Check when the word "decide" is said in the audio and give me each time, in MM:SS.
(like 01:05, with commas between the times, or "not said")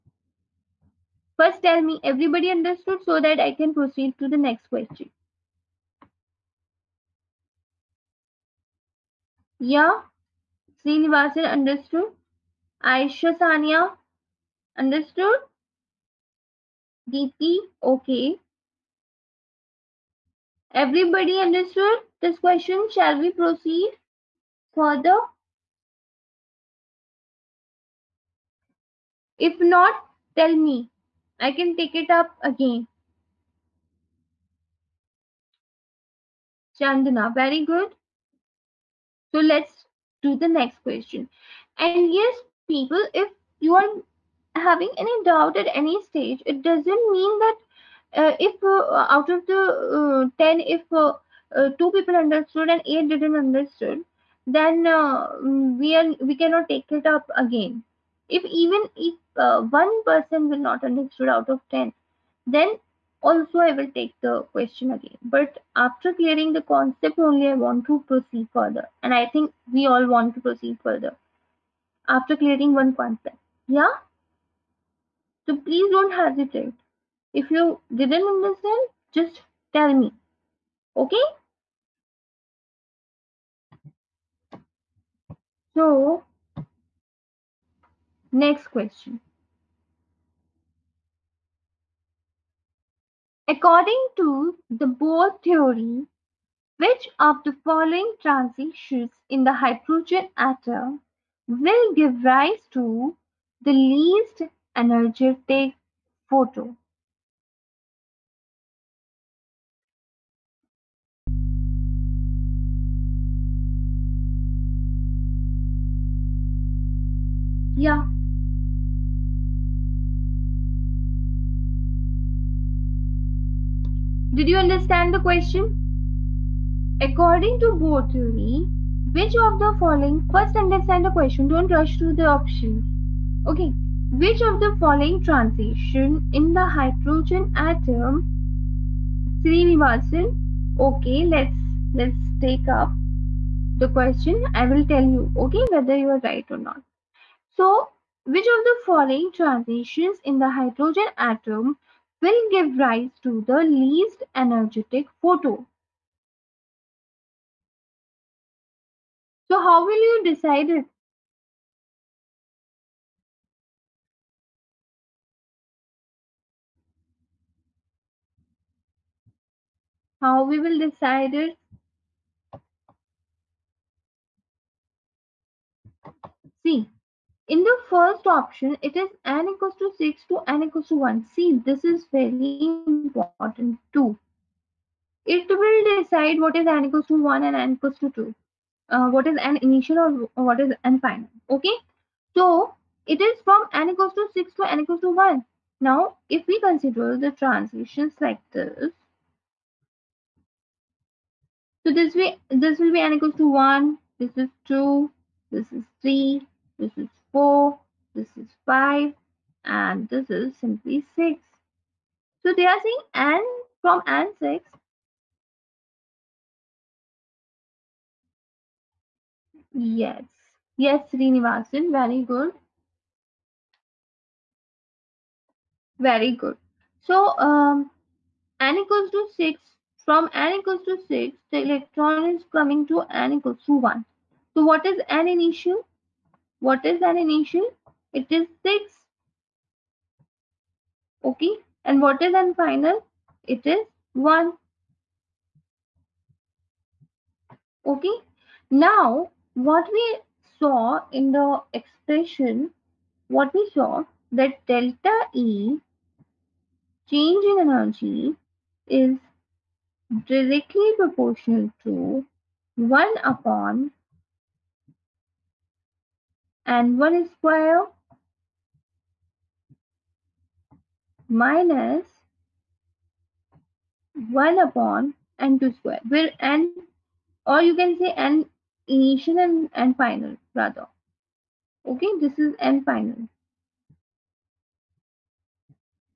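02:40, 02:50, 03:05.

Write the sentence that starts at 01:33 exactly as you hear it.
According to the Bohr theory, which of the following transitions in the hydrogen atom will give rise to the least energetic photon?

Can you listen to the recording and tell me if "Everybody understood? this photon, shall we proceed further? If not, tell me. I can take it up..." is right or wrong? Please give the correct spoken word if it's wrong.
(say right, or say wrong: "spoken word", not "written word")
wrong: "question", not "photon".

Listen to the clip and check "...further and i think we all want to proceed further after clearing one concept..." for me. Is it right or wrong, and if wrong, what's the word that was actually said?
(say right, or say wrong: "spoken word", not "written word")
right.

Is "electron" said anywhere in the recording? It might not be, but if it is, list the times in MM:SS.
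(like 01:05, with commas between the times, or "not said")
03:51.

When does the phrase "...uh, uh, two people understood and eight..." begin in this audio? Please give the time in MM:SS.
00:50.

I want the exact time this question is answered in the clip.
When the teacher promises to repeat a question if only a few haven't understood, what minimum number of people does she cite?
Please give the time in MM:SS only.
00:59.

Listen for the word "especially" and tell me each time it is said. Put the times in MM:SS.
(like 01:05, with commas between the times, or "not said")
not said.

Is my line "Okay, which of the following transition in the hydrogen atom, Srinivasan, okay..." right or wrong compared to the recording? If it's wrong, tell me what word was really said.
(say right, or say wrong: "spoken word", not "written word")
right.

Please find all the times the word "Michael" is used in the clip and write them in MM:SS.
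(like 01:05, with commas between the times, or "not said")
not said.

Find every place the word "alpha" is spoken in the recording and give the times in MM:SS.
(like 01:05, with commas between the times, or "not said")
not said.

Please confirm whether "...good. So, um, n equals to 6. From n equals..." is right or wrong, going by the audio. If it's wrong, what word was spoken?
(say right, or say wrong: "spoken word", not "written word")
right.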